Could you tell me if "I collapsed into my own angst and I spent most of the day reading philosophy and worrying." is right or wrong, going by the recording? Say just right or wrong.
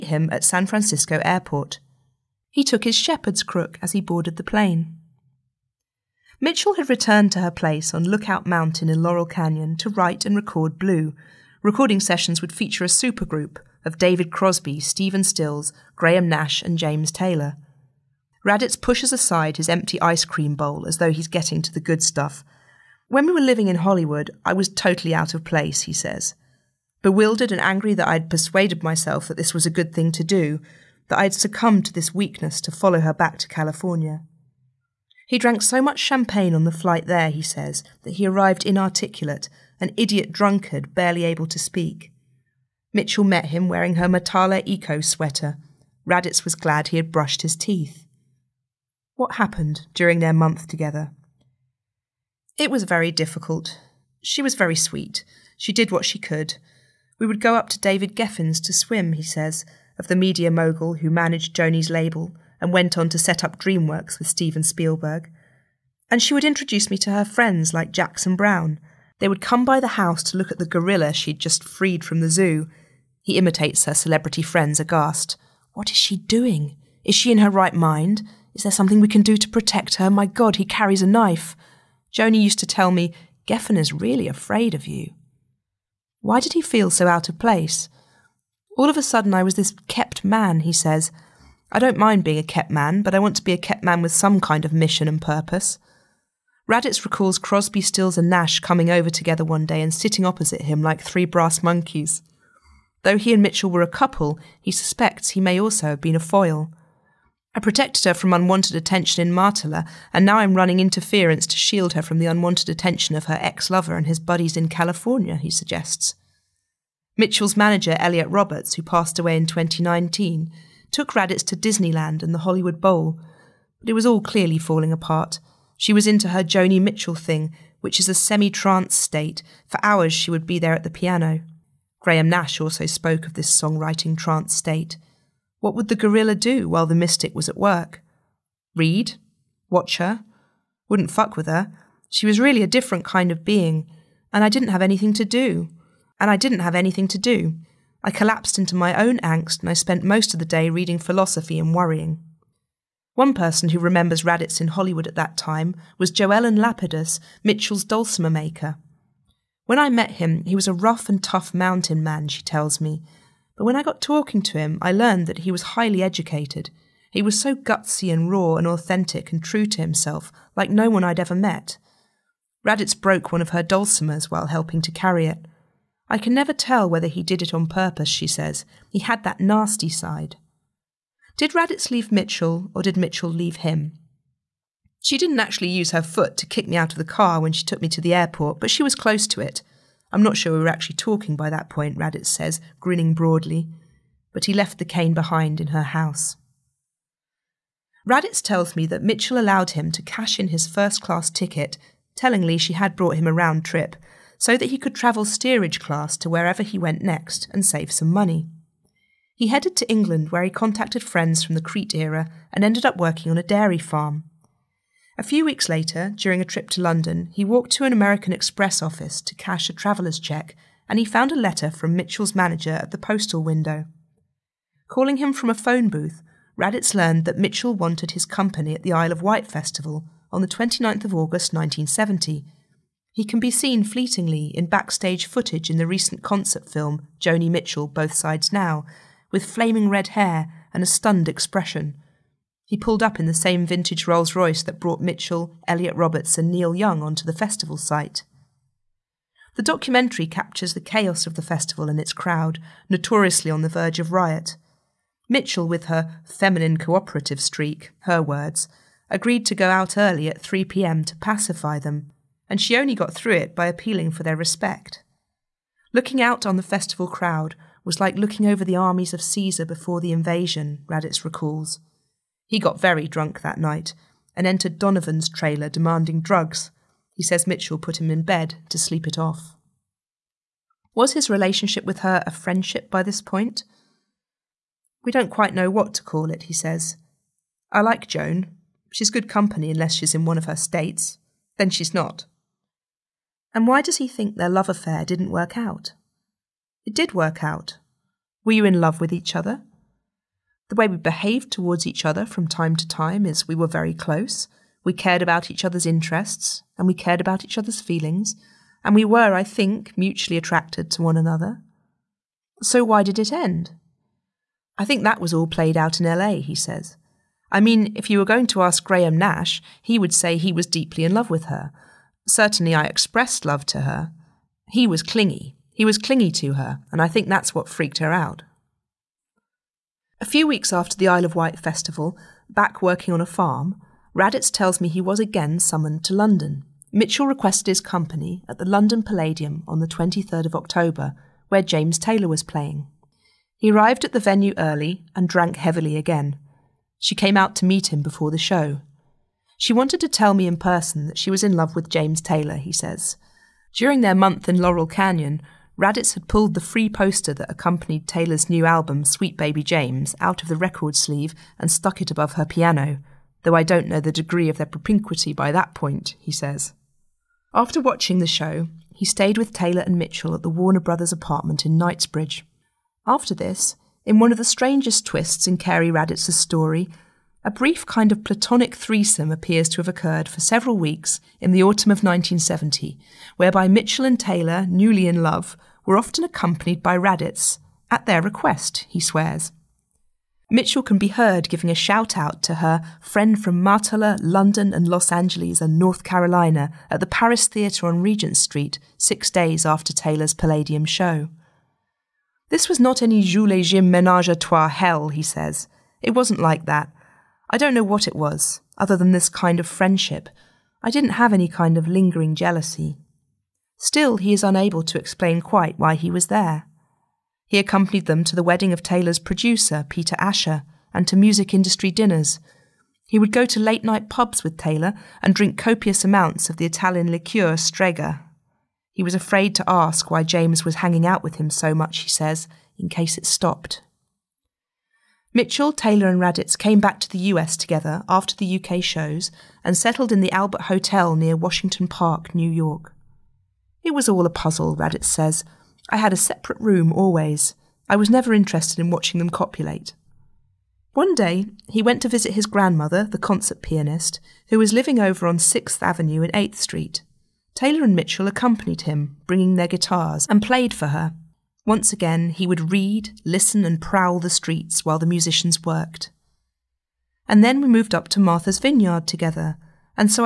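right.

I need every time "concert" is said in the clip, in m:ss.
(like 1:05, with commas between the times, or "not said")
3:56, 7:33.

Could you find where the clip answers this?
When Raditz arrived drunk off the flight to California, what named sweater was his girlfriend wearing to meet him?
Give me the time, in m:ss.
0:44.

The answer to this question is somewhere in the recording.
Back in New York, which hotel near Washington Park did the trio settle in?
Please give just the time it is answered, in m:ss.
7:20.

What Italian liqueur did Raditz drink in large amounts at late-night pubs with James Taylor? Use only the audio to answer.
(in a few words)
Strega.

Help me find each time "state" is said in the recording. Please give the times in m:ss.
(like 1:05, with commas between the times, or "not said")
2:08, 2:14, 4:50.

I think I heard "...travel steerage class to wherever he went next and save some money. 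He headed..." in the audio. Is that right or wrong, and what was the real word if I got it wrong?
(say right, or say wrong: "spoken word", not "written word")
right.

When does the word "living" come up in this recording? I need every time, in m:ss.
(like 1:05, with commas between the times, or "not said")
0:23, 7:34.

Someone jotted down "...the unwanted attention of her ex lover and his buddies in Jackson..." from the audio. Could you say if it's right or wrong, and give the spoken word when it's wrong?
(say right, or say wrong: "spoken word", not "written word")
wrong: "California", not "Jackson".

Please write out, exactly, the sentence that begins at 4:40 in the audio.
Was his relationship with her a friendship by this point?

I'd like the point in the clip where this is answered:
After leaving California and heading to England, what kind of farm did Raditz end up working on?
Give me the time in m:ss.
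3:33.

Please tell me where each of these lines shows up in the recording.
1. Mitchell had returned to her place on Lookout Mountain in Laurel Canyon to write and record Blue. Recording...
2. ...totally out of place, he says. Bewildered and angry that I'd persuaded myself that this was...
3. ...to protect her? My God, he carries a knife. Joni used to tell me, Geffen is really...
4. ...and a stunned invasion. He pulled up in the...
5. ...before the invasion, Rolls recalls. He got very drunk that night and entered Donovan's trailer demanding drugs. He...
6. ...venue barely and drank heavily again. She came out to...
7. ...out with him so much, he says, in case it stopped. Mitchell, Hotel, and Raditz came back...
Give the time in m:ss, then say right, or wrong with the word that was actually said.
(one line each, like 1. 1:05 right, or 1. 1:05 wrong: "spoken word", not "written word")
1. 0:06 right
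2. 0:24 right
3. 1:19 right
4. 4:00 wrong: "expression", not "invasion"
5. 4:29 wrong: "Raditz", not "Rolls"
6. 5:44 wrong: "early", not "barely"
7. 7:11 wrong: "Taylor", not "Hotel".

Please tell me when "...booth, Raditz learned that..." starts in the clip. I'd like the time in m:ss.
3:45.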